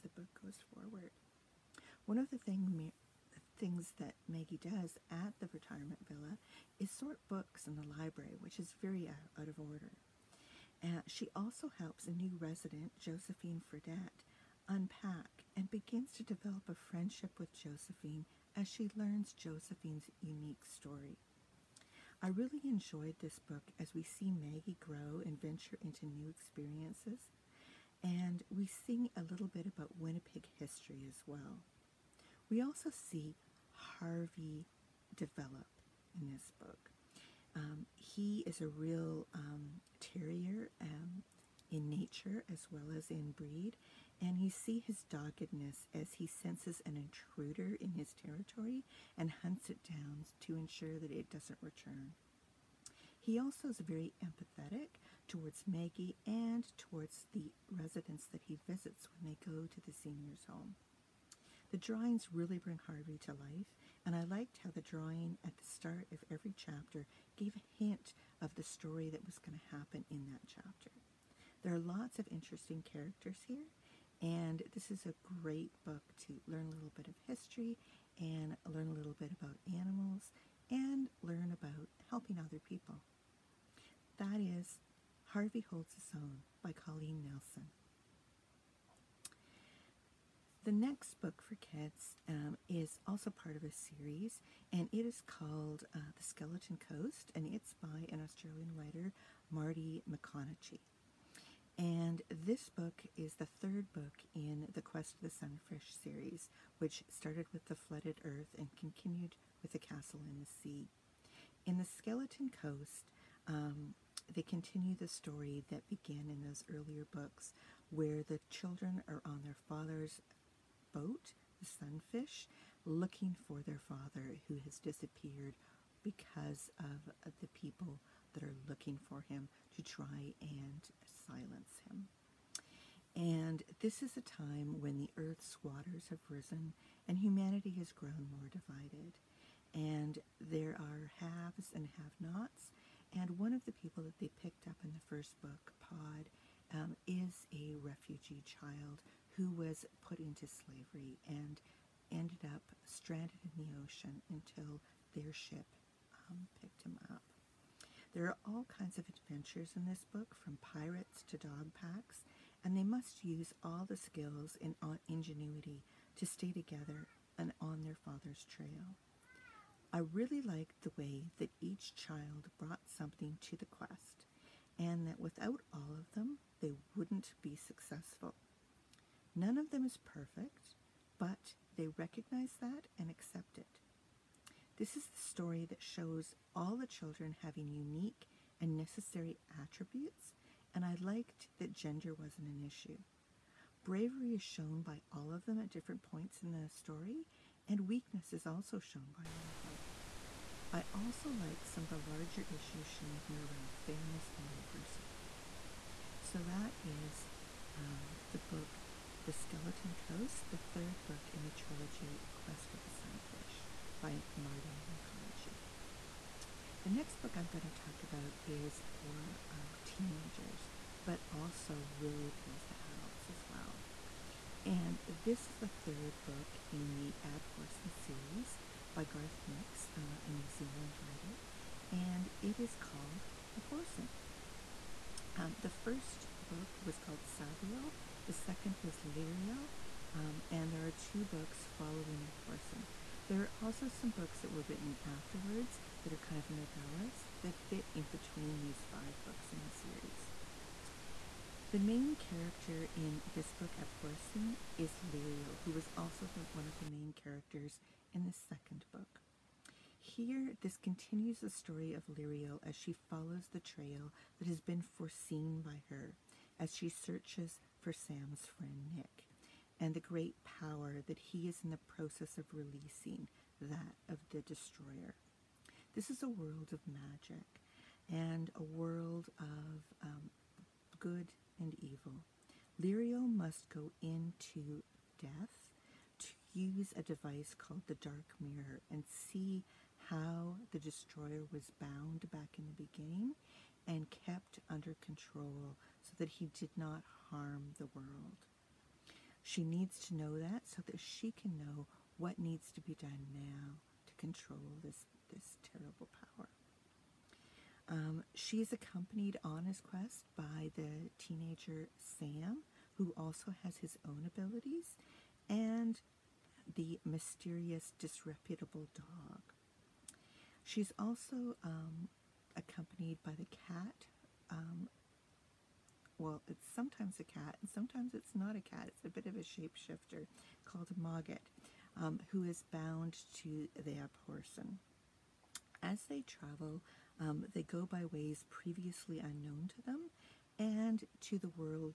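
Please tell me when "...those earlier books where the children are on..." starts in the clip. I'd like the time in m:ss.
1:56.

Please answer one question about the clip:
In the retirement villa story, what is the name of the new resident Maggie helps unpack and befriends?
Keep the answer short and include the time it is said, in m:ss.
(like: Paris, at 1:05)
Josephine Fredette, at 0:12.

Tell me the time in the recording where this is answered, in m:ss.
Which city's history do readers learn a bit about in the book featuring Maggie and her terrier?
0:29.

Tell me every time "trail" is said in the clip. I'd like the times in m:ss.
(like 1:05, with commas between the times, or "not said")
2:48, 4:23.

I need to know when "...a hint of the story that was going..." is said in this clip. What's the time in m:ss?
1:07.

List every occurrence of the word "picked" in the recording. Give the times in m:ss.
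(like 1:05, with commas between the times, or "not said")
2:24, 2:36.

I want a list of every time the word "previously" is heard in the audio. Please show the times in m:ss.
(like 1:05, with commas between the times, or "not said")
5:38.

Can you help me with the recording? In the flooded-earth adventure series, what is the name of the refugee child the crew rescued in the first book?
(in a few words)
Pod.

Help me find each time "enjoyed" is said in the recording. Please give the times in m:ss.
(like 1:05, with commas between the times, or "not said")
0:22.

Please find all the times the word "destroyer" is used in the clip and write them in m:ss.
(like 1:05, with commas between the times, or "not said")
4:34, 4:50.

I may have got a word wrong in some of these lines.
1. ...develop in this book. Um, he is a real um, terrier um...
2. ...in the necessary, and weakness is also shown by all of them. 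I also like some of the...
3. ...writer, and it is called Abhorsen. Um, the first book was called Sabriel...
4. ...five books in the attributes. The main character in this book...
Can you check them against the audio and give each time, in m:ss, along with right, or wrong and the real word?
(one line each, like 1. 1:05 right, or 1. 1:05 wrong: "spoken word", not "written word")
1. 0:35 right
2. 3:16 wrong: "story", not "necessary"
3. 3:50 right
4. 4:08 wrong: "series", not "attributes".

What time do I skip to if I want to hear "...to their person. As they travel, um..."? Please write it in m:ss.
5:33.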